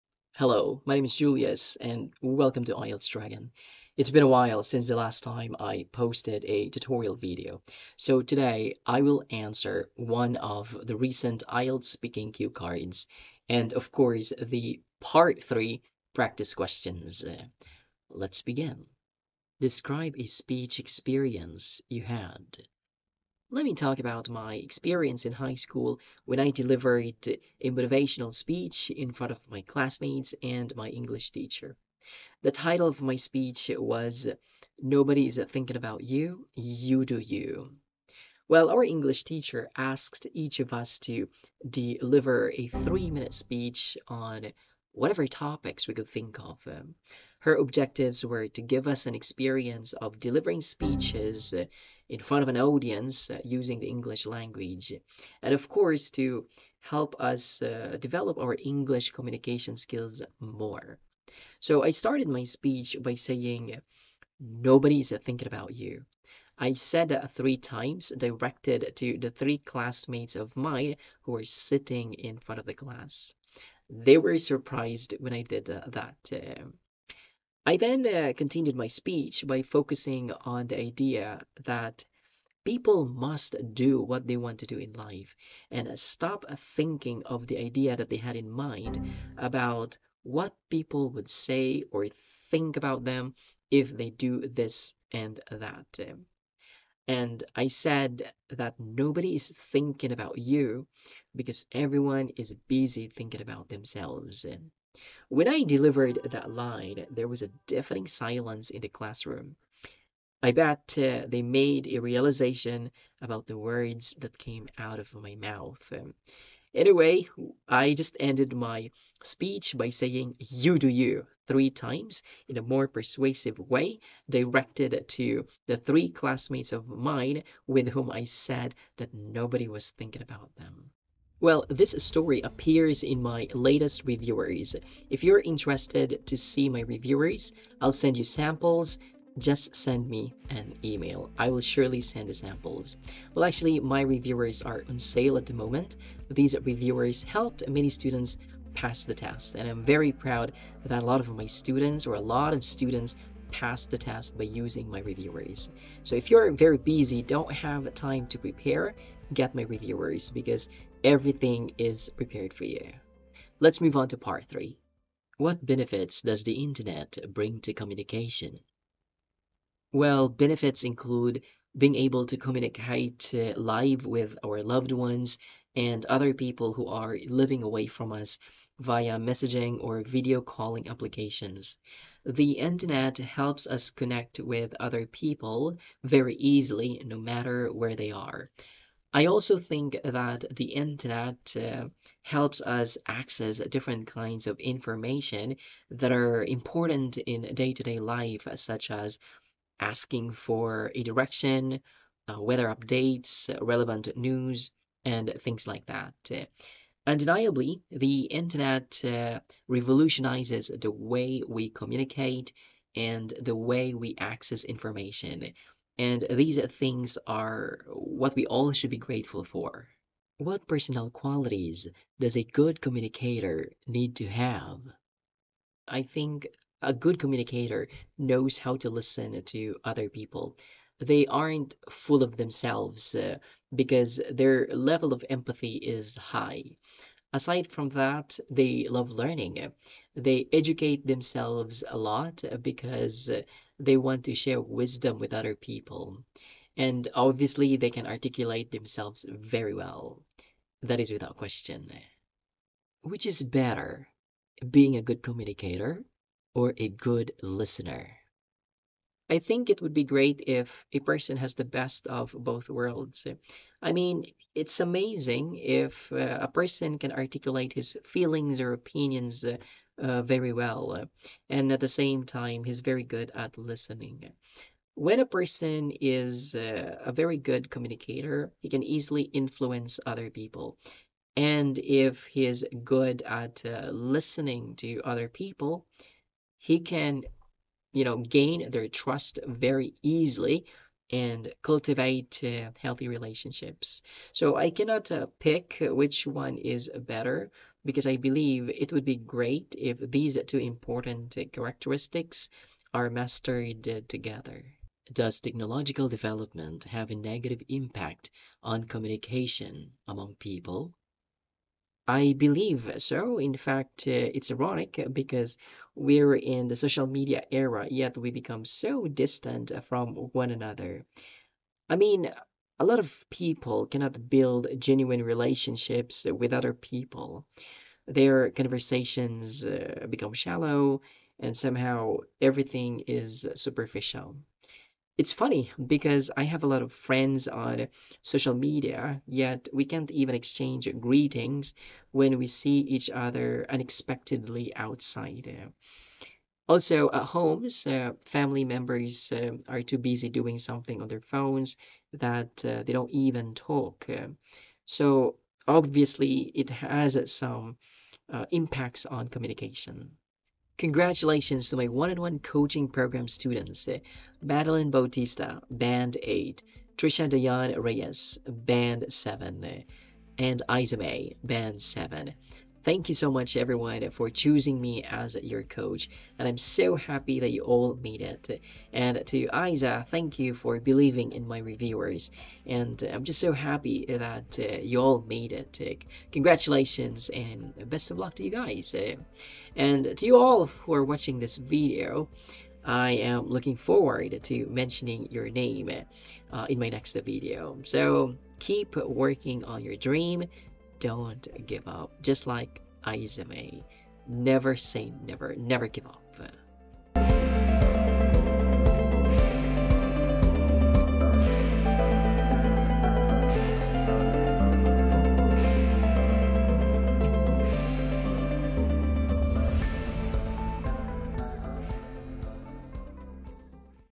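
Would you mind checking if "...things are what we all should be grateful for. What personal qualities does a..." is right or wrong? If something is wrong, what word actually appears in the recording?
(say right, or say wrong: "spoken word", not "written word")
right.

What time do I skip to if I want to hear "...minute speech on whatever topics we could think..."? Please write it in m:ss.
0:43.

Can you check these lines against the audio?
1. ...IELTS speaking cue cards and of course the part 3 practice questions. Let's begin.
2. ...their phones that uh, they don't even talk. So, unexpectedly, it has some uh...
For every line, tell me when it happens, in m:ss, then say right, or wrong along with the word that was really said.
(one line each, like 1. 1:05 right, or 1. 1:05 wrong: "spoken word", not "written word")
1. 0:11 right
2. 5:51 wrong: "obviously", not "unexpectedly".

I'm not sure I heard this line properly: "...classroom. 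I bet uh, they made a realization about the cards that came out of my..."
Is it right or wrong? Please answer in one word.
wrong.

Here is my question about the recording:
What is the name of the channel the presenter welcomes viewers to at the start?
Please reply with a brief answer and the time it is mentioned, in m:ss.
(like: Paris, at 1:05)
IELTS Dragon, at 0:02.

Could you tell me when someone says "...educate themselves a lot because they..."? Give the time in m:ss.
4:00.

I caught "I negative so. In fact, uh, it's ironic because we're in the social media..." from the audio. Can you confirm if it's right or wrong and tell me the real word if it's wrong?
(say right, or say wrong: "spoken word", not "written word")
wrong: "believe", not "negative".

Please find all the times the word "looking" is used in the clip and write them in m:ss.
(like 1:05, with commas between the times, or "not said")
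6:33.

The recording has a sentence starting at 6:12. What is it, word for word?
Thank you so much, everyone, for choosing me as your coach, and I'm so happy that you all made it.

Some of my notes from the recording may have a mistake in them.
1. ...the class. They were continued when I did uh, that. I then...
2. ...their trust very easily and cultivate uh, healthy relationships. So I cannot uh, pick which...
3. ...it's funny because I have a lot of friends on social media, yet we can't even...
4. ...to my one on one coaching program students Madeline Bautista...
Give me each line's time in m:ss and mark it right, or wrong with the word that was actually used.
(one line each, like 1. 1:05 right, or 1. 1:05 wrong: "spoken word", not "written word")
1. 1:12 wrong: "surprised", not "continued"
2. 4:48 right
3. 5:35 right
4. 6:01 right.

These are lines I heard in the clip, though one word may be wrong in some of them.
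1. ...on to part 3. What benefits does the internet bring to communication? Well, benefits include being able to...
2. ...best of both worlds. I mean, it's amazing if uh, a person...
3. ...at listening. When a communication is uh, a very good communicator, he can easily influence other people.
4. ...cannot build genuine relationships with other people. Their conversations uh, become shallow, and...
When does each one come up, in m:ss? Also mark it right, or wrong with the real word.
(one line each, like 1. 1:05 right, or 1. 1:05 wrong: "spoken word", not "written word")
1. 2:43 right
2. 4:21 right
3. 4:33 wrong: "person", not "communication"
4. 5:23 right.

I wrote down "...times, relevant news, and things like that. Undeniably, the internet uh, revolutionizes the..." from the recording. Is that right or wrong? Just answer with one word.
wrong.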